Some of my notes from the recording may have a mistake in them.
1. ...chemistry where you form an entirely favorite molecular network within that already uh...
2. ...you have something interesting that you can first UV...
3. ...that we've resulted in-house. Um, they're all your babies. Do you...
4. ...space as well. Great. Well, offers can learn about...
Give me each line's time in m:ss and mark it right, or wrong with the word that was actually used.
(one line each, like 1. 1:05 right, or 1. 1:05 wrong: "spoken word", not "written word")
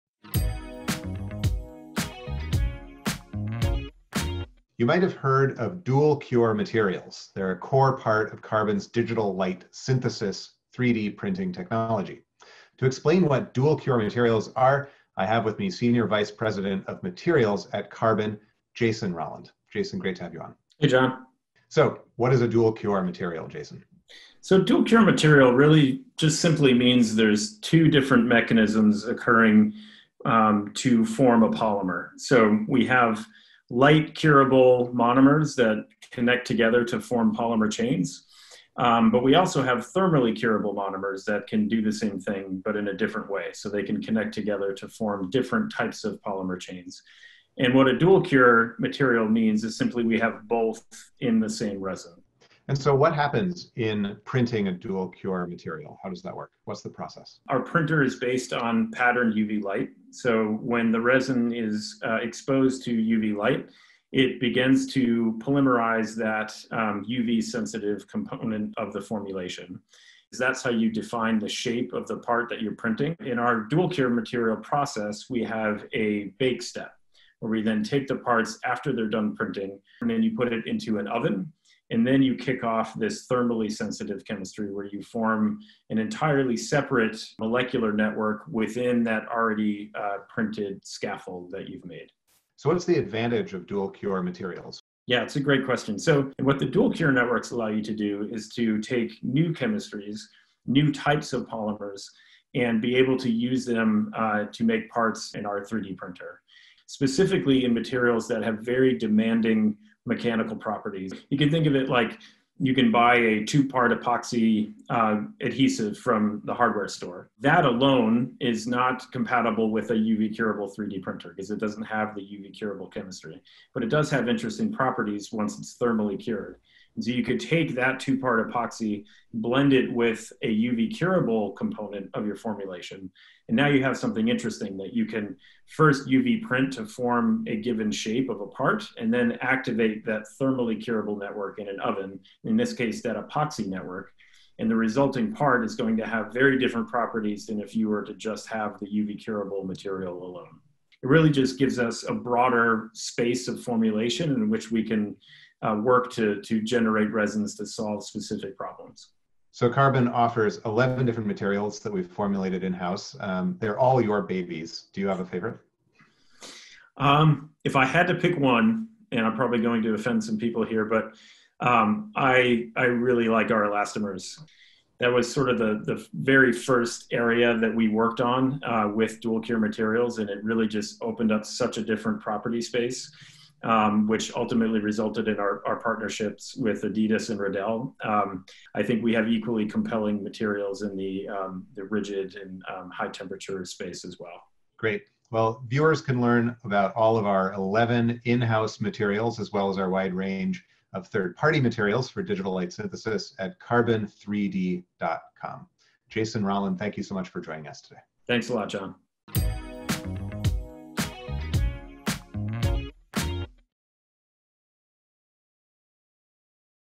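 1. 1:24 wrong: "separate", not "favorite"
2. 2:13 right
3. 2:41 wrong: "formulated", not "resulted"
4. 3:13 wrong: "viewers", not "offers".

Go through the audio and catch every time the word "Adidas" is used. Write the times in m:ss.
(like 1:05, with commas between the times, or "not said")
3:06.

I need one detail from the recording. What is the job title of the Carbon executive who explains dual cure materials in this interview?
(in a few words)
Senior Vice President of Materials.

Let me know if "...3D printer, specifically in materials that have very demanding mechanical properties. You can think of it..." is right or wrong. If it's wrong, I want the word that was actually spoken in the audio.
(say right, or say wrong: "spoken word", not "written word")
right.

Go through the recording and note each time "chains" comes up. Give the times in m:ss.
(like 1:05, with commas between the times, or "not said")
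0:37, 0:46.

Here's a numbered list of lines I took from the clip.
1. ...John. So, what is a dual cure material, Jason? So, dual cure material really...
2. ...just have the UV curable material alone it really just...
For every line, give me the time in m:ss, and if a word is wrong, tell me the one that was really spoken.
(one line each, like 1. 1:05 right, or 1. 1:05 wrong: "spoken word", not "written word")
1. 0:20 right
2. 2:28 right.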